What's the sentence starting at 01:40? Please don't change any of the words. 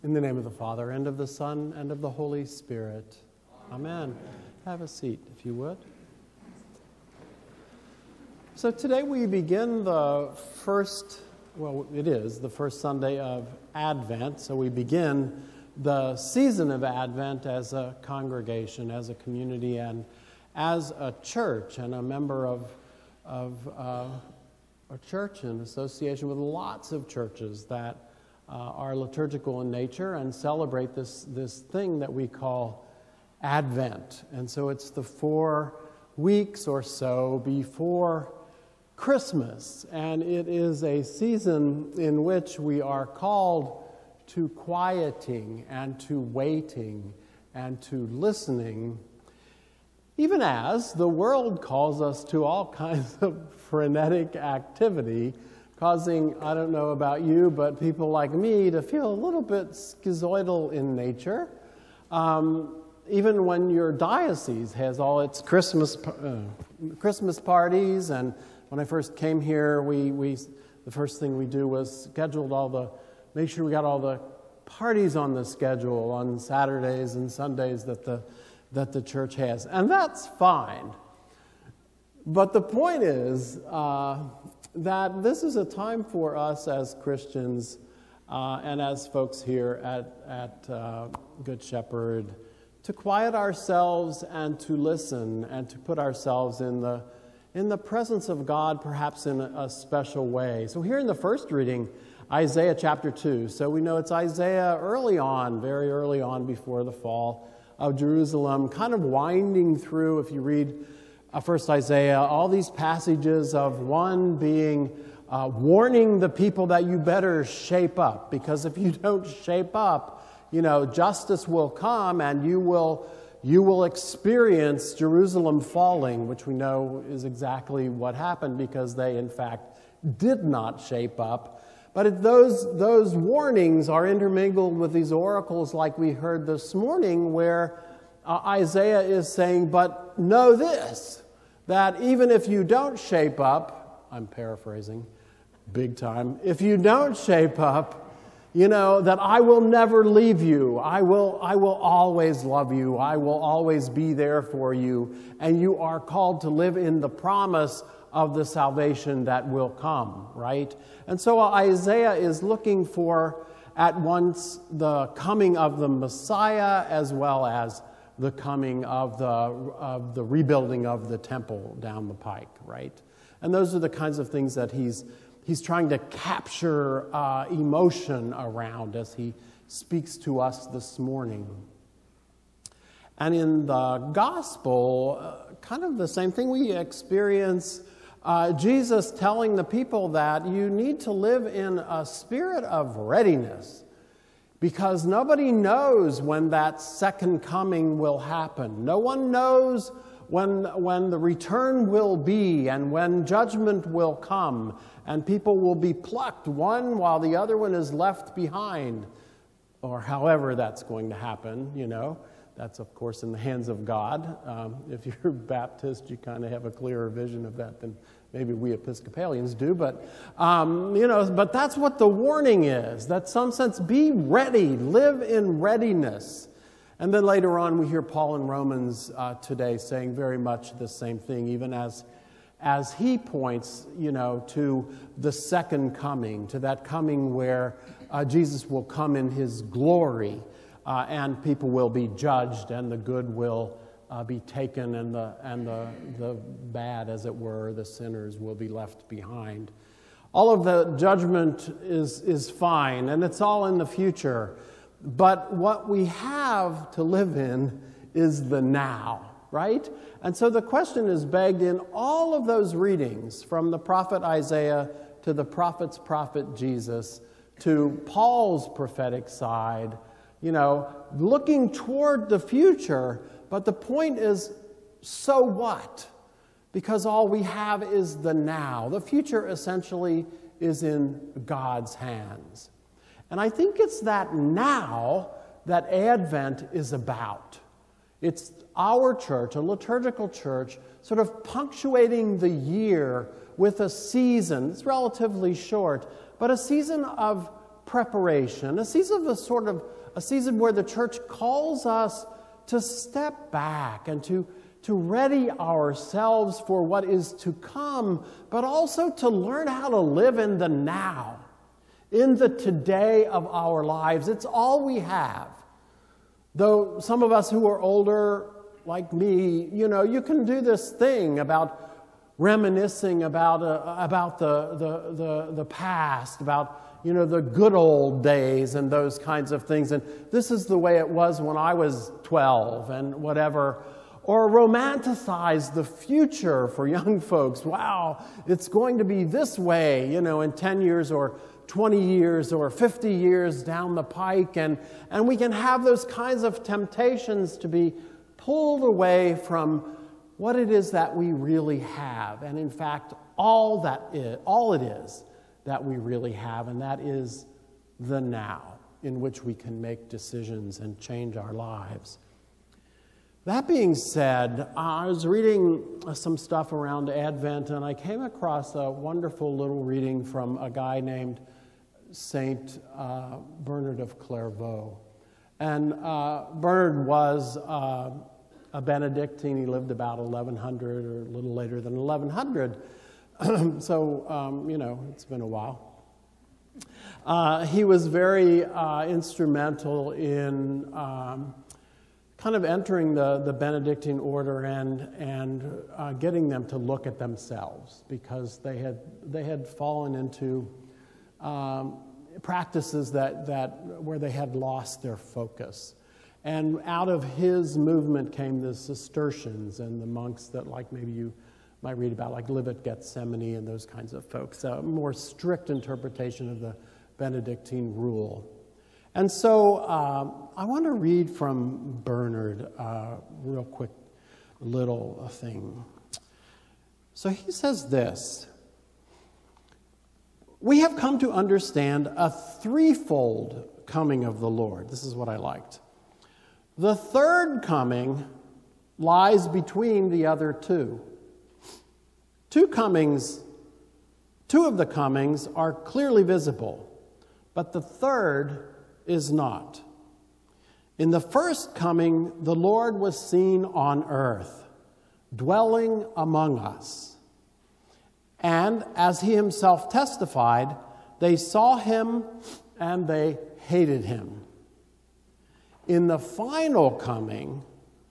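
So, here in the first reading, Isaiah chapter 2.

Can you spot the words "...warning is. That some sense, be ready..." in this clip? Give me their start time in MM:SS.
03:42.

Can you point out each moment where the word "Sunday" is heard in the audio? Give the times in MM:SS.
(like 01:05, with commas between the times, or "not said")
00:12, 01:17.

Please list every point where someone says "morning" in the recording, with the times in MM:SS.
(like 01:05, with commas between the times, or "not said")
02:16, 03:00.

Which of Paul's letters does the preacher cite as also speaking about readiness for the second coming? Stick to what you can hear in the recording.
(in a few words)
Romans.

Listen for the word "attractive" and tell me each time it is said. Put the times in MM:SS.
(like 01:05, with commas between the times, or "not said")
not said.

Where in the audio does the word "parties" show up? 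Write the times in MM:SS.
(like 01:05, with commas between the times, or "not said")
01:07, 01:14.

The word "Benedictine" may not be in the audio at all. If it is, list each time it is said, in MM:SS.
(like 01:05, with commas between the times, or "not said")
06:18, 06:33, 06:57.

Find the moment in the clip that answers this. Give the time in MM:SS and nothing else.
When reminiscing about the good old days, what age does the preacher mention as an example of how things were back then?
05:32.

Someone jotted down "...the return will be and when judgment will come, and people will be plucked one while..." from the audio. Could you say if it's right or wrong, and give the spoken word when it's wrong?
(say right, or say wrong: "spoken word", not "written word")
right.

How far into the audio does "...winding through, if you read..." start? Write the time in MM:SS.
01:49.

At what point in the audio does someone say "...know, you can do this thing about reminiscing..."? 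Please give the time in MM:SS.
05:19.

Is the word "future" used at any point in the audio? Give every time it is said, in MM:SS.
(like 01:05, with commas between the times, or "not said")
04:13, 04:32, 04:39, 05:35.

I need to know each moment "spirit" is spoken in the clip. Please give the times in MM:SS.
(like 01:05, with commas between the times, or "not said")
00:02, 03:12.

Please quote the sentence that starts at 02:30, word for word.
I will, I will always love you.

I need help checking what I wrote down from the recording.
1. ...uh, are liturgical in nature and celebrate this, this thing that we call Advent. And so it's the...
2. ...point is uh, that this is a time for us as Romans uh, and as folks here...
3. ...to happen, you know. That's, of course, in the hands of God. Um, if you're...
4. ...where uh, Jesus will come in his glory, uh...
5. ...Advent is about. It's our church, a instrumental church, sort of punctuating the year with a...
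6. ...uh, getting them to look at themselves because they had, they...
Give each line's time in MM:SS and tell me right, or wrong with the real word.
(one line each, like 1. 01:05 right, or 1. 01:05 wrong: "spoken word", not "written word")
1. 00:28 right
2. 01:22 wrong: "Christians", not "Romans"
3. 03:31 right
4. 03:57 right
5. 04:45 wrong: "liturgical", not "instrumental"
6. 06:35 right.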